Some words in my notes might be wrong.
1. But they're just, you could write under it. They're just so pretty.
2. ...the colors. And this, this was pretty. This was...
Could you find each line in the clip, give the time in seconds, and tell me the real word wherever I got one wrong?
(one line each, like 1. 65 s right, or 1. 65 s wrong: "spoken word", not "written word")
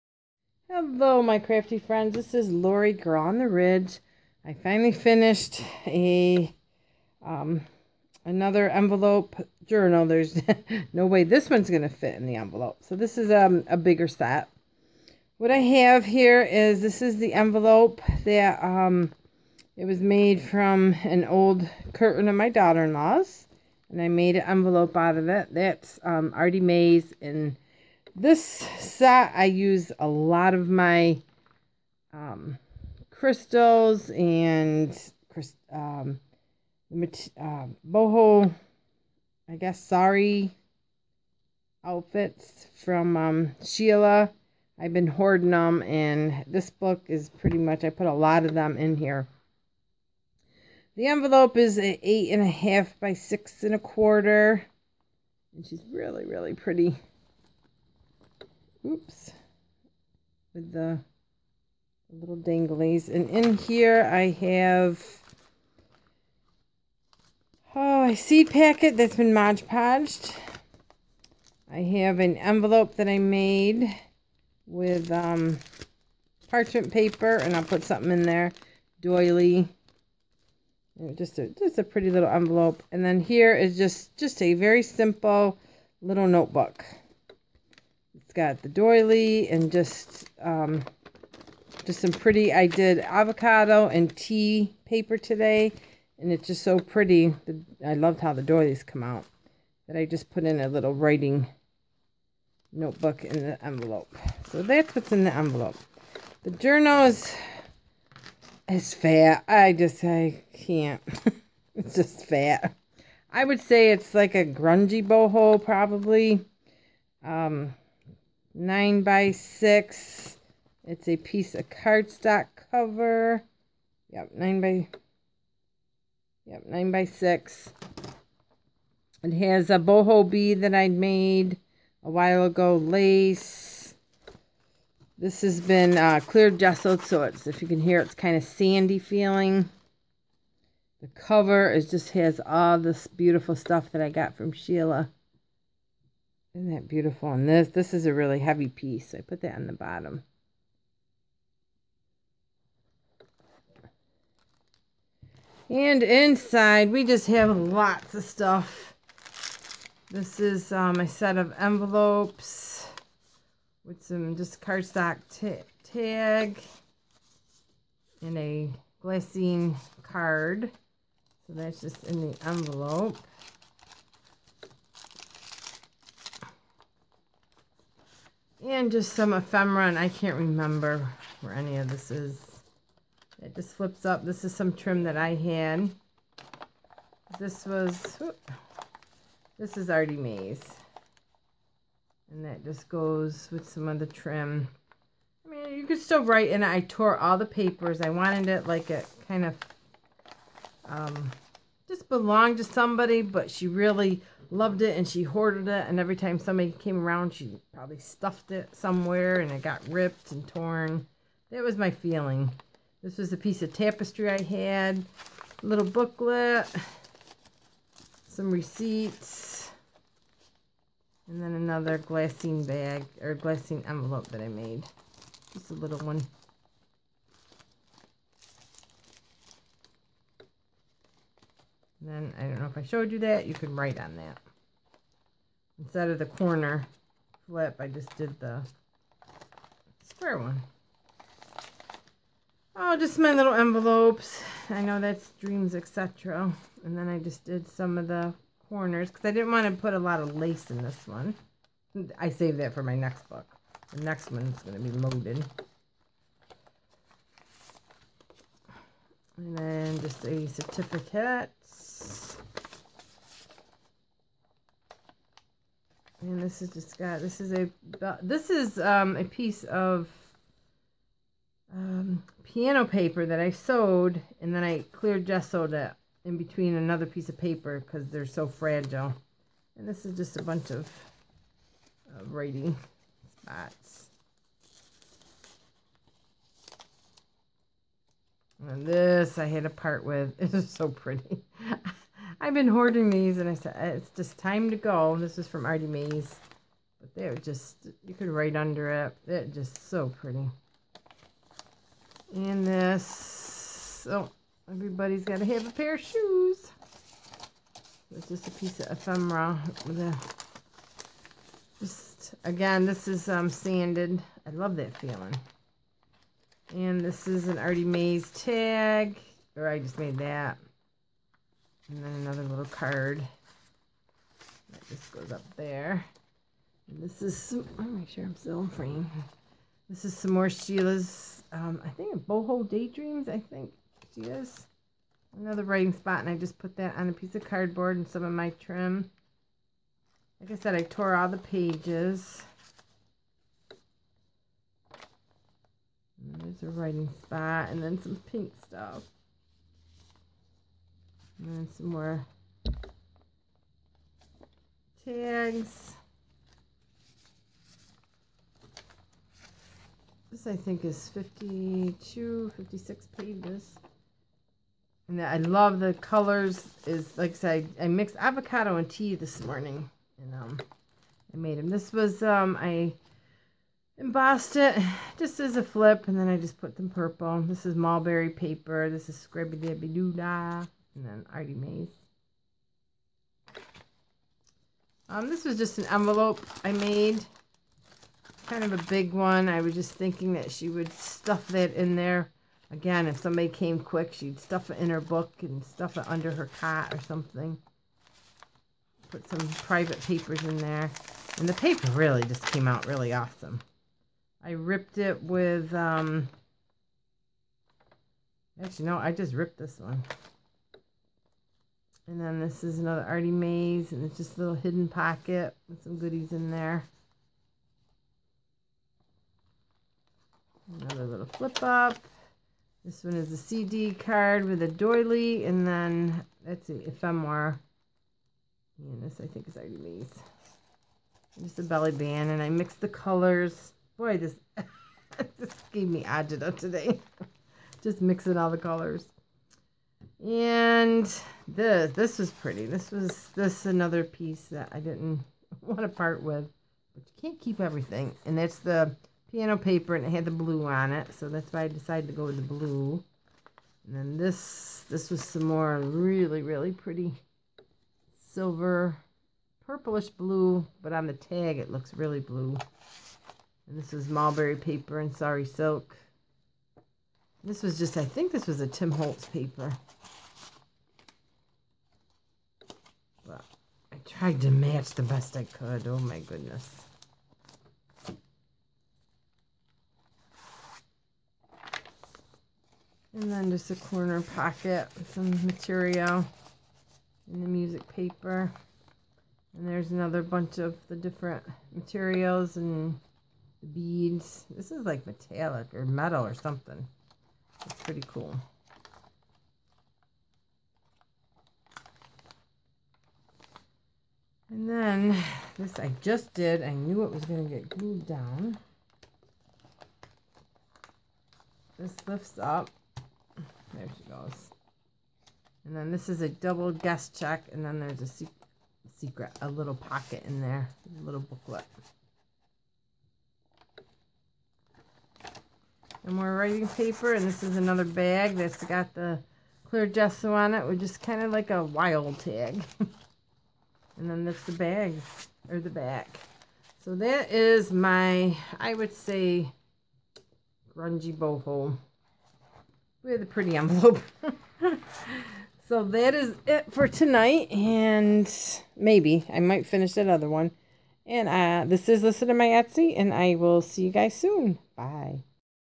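1. 296 s right
2. 438 s right.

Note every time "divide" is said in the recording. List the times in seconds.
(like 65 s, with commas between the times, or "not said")
not said.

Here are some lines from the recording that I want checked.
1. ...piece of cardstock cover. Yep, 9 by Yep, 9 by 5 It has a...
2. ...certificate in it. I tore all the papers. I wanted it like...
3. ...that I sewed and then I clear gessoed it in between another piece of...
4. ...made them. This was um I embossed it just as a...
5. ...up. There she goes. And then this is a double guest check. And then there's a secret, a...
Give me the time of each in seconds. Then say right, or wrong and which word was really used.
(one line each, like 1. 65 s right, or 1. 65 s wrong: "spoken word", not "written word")
1. 121 s wrong: "6", not "5"
2. 196 s wrong: "write", not "certificate"
3. 273 s right
4. 371 s right
5. 512 s right.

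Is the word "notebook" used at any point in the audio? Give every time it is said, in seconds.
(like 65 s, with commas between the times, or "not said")
86 s, 102 s.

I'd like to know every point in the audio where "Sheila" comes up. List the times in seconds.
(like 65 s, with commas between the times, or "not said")
43 s, 144 s, 330 s.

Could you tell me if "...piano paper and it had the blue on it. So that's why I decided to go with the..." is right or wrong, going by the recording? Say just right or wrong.
right.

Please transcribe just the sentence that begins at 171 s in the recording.
So that's just in the envelope.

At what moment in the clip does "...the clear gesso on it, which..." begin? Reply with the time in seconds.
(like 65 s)
528 s.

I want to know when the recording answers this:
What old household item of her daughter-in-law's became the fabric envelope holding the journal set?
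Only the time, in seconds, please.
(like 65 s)
21 s.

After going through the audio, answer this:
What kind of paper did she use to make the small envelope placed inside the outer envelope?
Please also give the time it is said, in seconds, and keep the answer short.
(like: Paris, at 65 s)
Parchment paper, at 76 s.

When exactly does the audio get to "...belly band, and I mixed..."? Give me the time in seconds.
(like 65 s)
431 s.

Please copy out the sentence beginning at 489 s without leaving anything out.
And there's another bunch of the different materials and the beads.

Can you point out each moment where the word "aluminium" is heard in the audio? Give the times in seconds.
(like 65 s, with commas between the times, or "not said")
not said.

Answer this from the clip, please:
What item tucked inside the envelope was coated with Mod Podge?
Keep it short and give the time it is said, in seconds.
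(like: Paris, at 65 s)
A seed packet, at 68 s.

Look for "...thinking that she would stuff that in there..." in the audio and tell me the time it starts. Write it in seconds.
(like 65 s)
389 s.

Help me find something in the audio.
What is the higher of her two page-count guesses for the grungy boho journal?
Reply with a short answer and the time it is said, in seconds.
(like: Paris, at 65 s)
56, at 362 s.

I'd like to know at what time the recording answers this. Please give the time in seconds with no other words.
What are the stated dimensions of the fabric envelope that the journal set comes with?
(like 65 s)
51 s.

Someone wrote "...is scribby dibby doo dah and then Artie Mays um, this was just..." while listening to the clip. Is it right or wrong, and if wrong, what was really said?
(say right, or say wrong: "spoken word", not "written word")
right.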